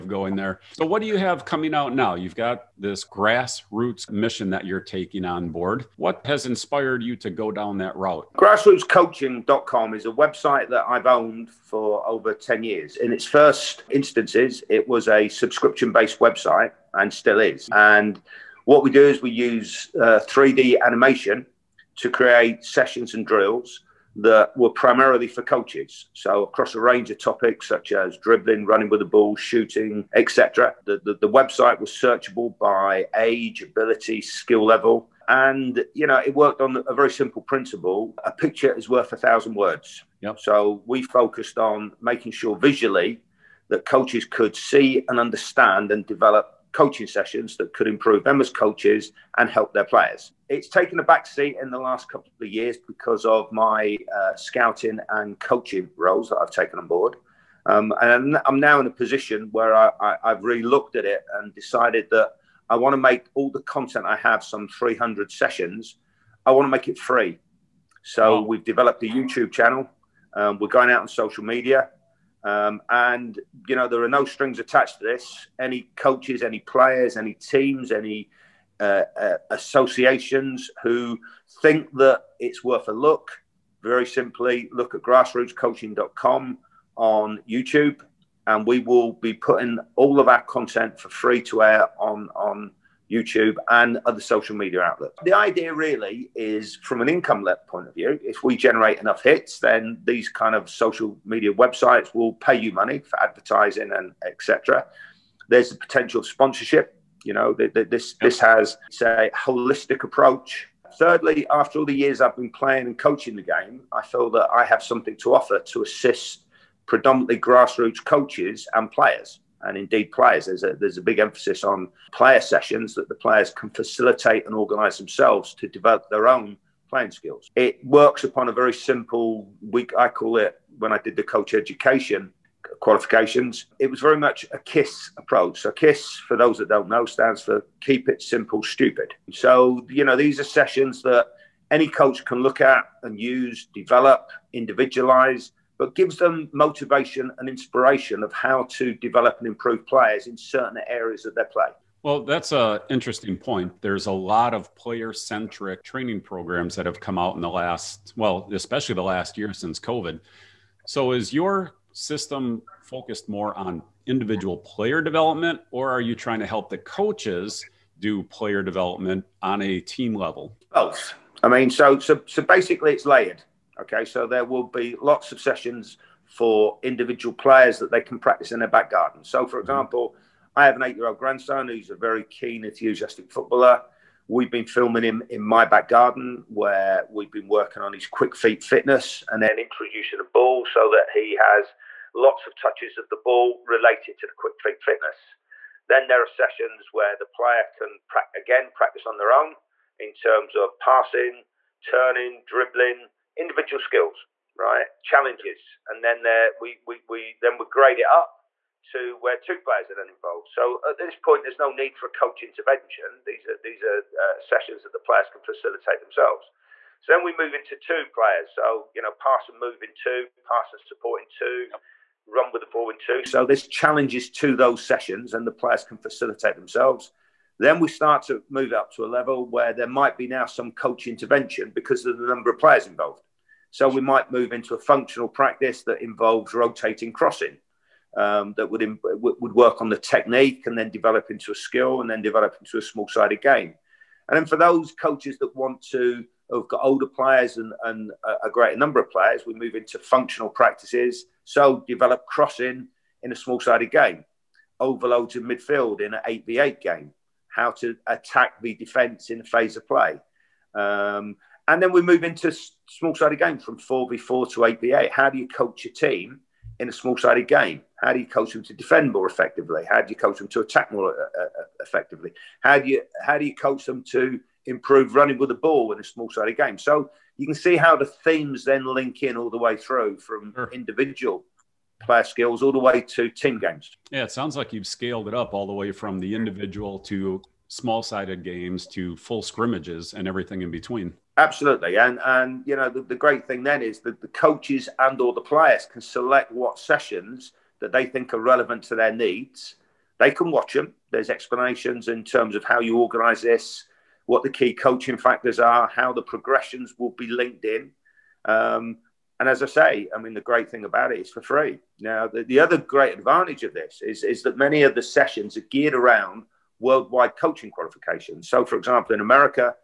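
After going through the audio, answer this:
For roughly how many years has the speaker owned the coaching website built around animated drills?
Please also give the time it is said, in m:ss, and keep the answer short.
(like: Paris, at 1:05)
over 10 years, at 0:12.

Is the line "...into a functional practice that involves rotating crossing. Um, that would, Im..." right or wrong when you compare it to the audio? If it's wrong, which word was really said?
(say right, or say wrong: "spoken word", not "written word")
right.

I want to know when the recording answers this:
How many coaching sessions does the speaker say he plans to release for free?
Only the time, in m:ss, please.
1:04.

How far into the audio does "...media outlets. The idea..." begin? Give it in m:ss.
1:34.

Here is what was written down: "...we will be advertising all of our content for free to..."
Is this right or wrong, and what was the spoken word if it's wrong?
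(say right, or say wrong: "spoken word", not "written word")
wrong: "putting", not "advertising".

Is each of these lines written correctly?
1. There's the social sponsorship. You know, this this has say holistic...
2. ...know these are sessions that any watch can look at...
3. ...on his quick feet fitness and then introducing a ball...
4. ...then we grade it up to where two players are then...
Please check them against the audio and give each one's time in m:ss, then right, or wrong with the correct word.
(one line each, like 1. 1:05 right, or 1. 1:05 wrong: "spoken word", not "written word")
1. 1:45 wrong: "potential", not "social"
2. 2:20 wrong: "coach", not "watch"
3. 3:07 right
4. 3:27 right.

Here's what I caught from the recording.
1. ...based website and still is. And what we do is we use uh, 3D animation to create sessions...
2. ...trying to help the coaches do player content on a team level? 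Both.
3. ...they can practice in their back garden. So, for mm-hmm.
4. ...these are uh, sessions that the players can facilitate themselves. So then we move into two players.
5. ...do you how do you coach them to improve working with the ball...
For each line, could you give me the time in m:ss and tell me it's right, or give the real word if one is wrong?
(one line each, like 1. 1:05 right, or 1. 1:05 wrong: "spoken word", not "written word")
1. 0:15 right
2. 2:46 wrong: "development", not "content"
3. 2:57 right
4. 3:33 right
5. 4:32 wrong: "running", not "working".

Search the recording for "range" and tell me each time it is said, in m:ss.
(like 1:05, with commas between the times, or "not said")
0:26.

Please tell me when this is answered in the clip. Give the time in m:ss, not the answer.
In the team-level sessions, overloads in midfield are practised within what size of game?
4:16.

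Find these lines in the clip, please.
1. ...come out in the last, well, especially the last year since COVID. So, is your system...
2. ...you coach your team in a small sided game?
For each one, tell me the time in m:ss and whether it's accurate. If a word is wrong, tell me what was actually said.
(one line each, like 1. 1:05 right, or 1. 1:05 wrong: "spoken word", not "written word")
1. 2:36 right
2. 4:25 right.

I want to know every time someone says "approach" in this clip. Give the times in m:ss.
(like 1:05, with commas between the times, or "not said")
1:50, 2:15.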